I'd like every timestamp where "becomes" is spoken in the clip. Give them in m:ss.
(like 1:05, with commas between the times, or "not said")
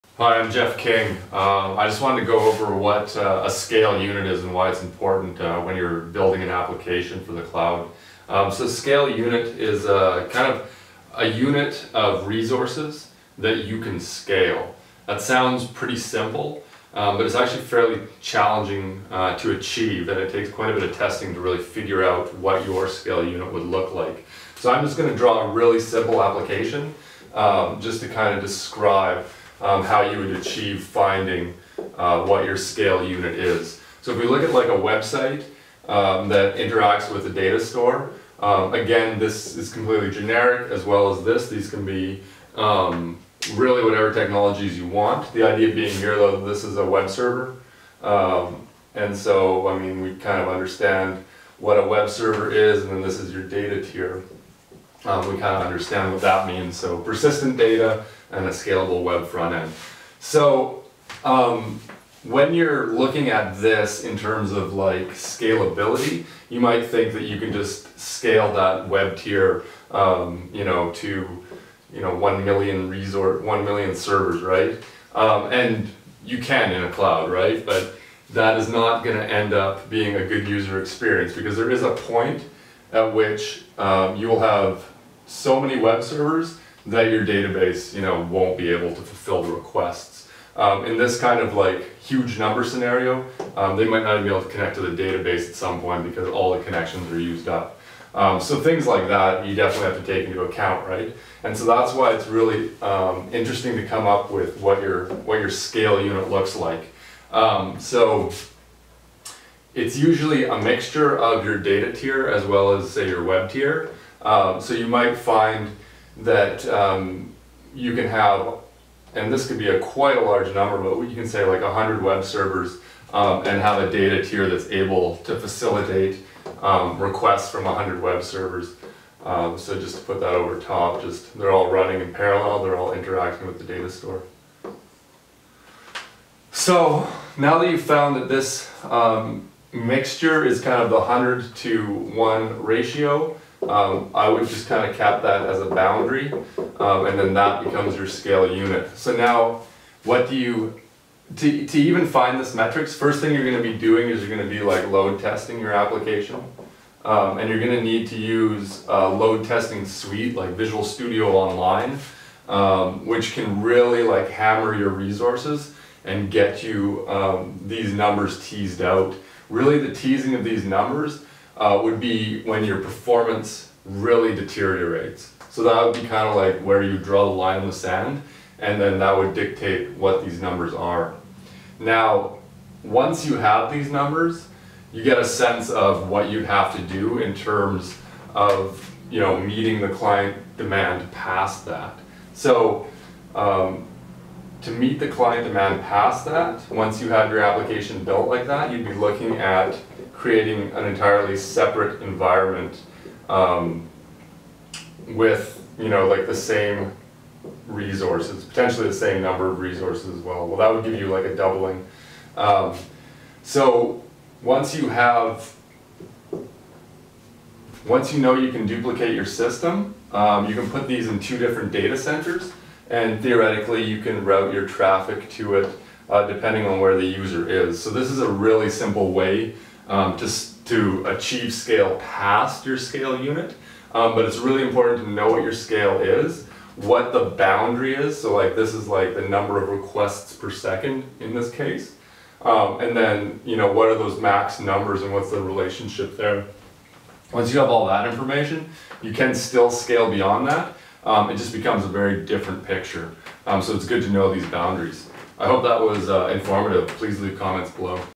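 2:27, 4:11.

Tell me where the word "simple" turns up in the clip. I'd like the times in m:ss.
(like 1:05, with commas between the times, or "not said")
0:15, 0:25, 3:48.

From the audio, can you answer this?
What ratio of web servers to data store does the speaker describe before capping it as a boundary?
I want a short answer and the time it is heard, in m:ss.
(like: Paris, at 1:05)
100 to 1, at 2:20.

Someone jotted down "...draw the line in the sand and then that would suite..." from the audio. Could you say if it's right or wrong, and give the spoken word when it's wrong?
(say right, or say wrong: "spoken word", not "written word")
wrong: "dictate", not "suite".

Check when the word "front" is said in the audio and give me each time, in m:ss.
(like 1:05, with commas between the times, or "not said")
0:59.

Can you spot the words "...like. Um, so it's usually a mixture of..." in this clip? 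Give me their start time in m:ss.
1:46.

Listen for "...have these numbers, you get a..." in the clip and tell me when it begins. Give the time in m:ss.
3:03.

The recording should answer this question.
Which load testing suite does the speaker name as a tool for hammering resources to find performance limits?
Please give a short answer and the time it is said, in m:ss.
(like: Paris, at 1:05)
Visual Studio Online, at 2:40.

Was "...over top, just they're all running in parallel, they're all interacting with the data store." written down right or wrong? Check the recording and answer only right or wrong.
right.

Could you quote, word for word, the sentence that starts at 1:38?
Um, so things like that you definitely have to take into account, right?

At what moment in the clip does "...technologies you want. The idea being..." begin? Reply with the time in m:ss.
0:44.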